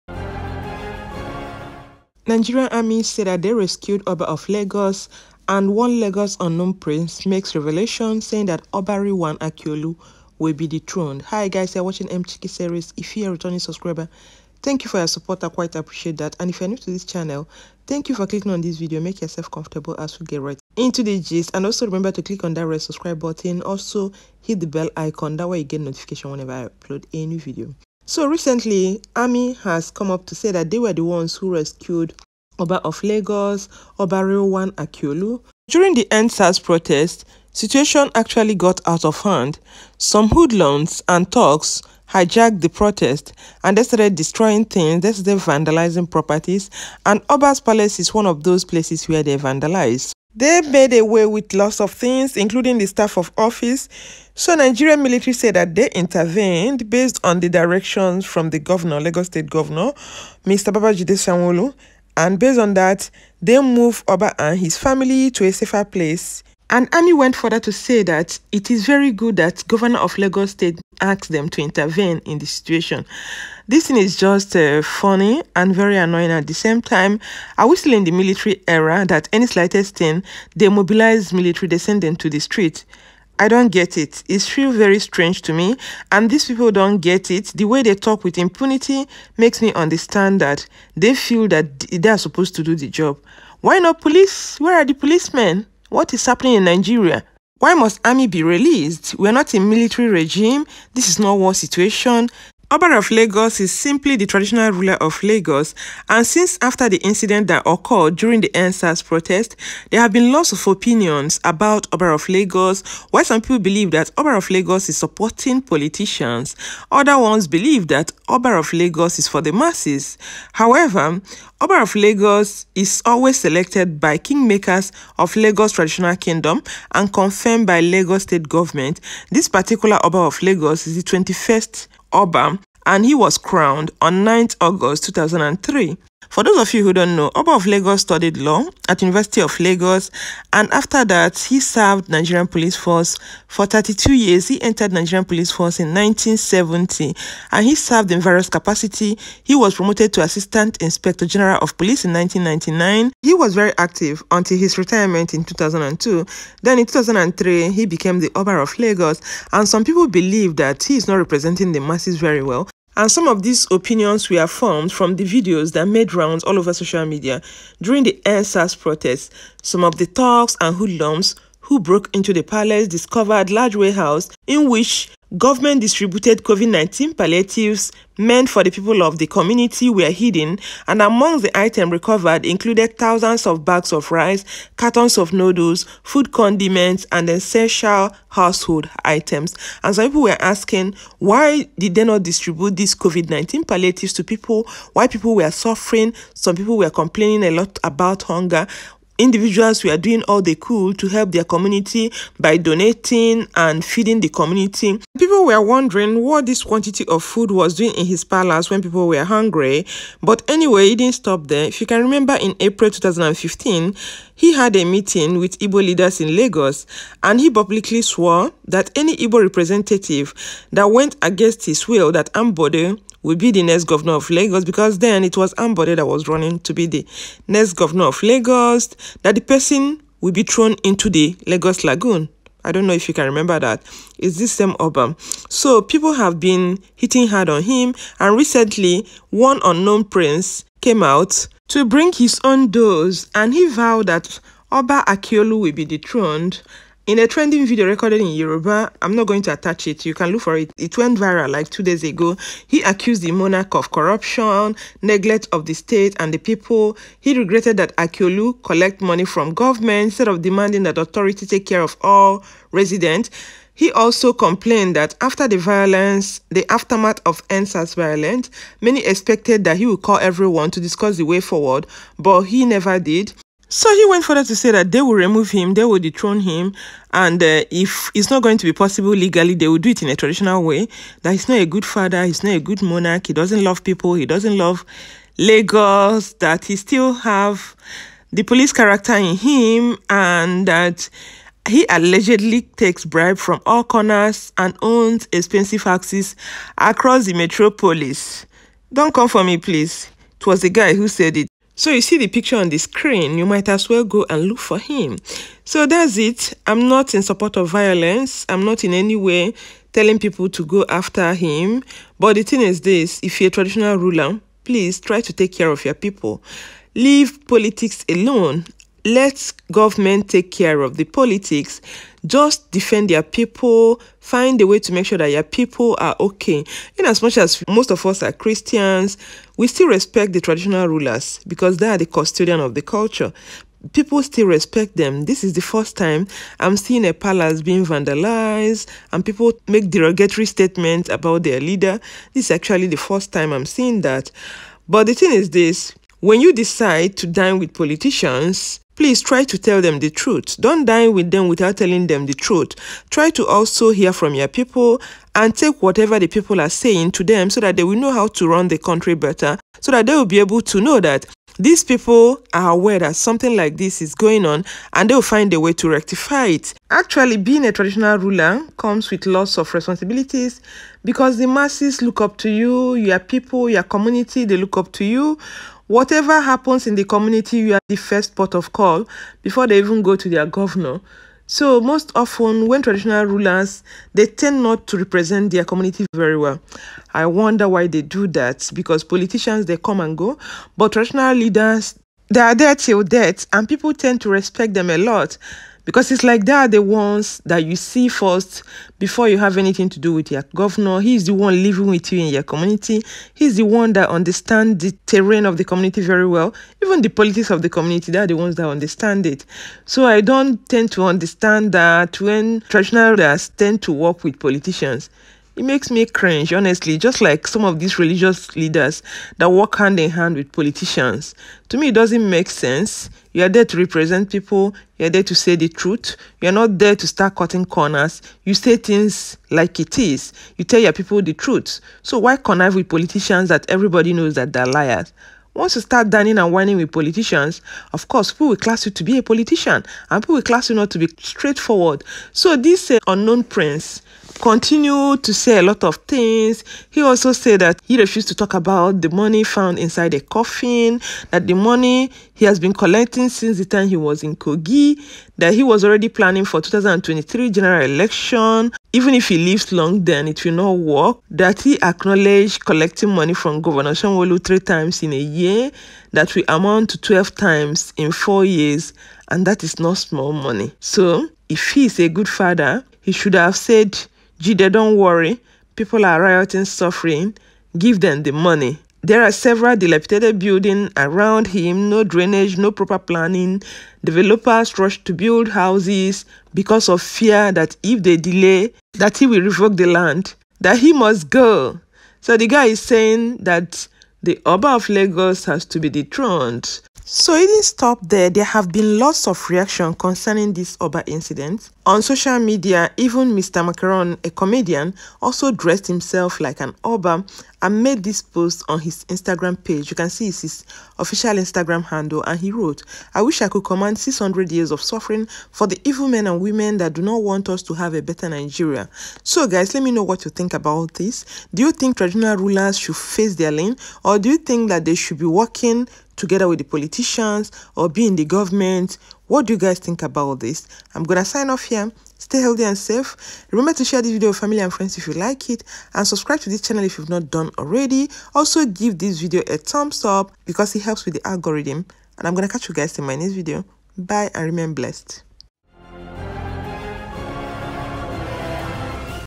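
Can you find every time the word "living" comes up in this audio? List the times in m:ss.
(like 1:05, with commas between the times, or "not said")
6:41.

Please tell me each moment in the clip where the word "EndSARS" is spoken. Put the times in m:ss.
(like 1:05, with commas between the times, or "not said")
0:36, 1:48, 2:48, 4:27.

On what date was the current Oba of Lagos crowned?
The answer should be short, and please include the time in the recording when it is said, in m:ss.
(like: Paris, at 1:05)
9 August 2003, at 2:14.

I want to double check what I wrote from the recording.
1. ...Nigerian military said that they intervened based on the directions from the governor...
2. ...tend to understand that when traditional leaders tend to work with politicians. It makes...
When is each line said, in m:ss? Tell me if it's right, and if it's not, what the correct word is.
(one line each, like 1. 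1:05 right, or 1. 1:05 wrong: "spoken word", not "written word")
1. 0:54 right
2. 6:50 right.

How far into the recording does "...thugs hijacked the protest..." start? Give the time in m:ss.
0:41.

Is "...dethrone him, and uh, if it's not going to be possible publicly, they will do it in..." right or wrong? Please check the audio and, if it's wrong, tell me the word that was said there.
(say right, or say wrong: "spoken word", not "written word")
wrong: "legally", not "publicly".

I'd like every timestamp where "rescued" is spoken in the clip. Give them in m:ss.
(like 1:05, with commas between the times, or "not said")
0:03, 0:31.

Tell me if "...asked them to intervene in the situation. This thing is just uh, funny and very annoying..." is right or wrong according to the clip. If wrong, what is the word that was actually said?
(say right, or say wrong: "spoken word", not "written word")
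right.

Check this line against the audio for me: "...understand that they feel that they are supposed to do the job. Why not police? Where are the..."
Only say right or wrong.
right.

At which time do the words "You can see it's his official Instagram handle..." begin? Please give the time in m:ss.
8:29.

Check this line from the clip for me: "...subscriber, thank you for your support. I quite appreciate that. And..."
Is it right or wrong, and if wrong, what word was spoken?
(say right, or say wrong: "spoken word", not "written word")
right.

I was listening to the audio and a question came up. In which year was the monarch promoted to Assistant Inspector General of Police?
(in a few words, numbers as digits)
1999.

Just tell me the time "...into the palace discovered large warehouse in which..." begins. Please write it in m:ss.
2:52.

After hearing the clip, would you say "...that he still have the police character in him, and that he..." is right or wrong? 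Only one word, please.
right.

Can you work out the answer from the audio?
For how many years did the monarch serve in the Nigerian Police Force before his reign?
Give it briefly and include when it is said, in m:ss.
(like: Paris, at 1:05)
32, at 2:23.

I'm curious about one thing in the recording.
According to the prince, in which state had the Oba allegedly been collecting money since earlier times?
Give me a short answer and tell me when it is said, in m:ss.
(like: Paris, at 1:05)
Kogi, at 7:34.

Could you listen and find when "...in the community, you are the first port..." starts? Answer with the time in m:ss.
6:16.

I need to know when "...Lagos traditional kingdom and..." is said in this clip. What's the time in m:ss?
2:05.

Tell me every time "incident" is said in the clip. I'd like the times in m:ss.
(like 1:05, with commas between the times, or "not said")
1:47, 8:21.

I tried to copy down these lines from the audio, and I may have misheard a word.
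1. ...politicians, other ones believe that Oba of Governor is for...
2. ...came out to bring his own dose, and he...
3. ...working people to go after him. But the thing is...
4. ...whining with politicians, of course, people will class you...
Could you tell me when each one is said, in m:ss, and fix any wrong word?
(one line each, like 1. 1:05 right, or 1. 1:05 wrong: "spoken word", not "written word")
1. 1:55 wrong: "Lagos", not "Governor"
2. 4:00 right
3. 5:09 wrong: "telling", not "working"
4. 7:16 right.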